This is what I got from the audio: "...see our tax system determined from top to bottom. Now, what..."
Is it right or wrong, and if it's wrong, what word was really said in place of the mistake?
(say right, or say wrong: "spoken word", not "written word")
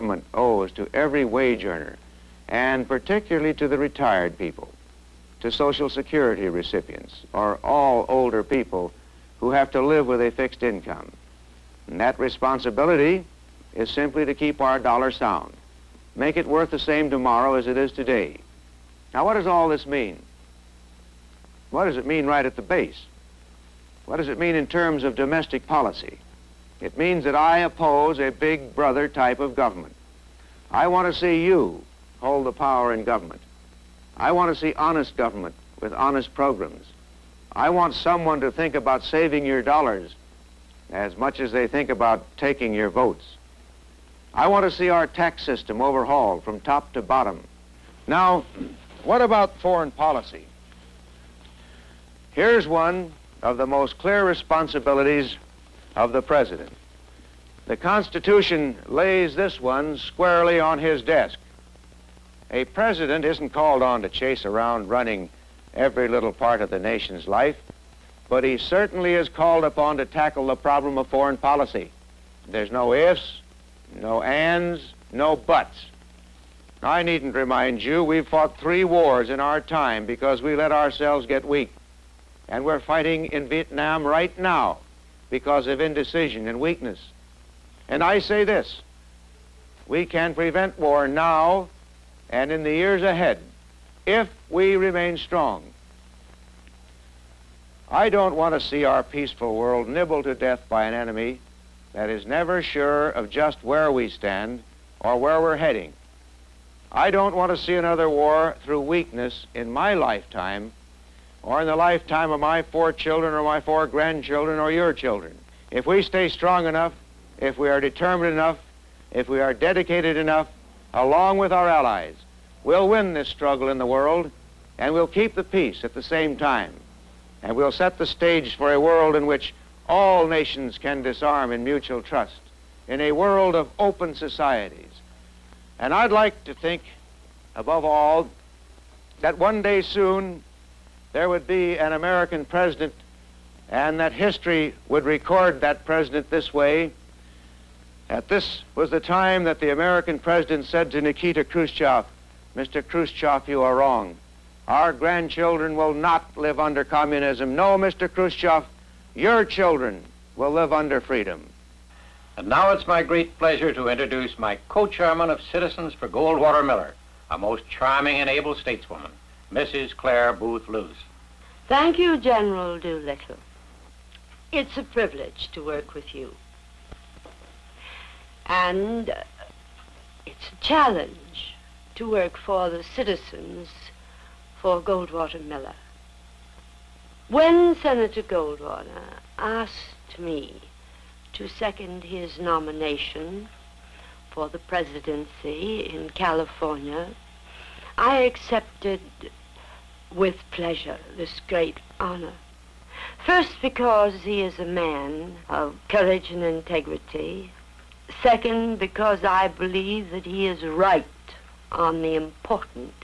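wrong: "overhauled", not "determined".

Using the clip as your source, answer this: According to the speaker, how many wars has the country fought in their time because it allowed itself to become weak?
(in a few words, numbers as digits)
3.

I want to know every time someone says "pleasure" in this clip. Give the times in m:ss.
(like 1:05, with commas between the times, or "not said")
2:43, 3:20.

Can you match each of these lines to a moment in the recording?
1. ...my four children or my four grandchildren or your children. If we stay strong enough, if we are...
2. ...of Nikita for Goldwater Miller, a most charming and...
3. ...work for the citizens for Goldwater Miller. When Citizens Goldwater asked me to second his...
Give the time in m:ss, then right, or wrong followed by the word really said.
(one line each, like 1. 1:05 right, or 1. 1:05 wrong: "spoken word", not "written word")
1. 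1:52 right
2. 2:45 wrong: "Citizens", not "Nikita"
3. 3:02 wrong: "Senator", not "Citizens".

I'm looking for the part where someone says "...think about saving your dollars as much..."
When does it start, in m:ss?
0:38.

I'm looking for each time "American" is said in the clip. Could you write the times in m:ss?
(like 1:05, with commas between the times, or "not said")
2:21, 2:29.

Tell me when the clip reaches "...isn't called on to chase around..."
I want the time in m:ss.
1:03.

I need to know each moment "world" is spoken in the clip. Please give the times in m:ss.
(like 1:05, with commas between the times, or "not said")
1:39, 2:03, 2:08, 2:13.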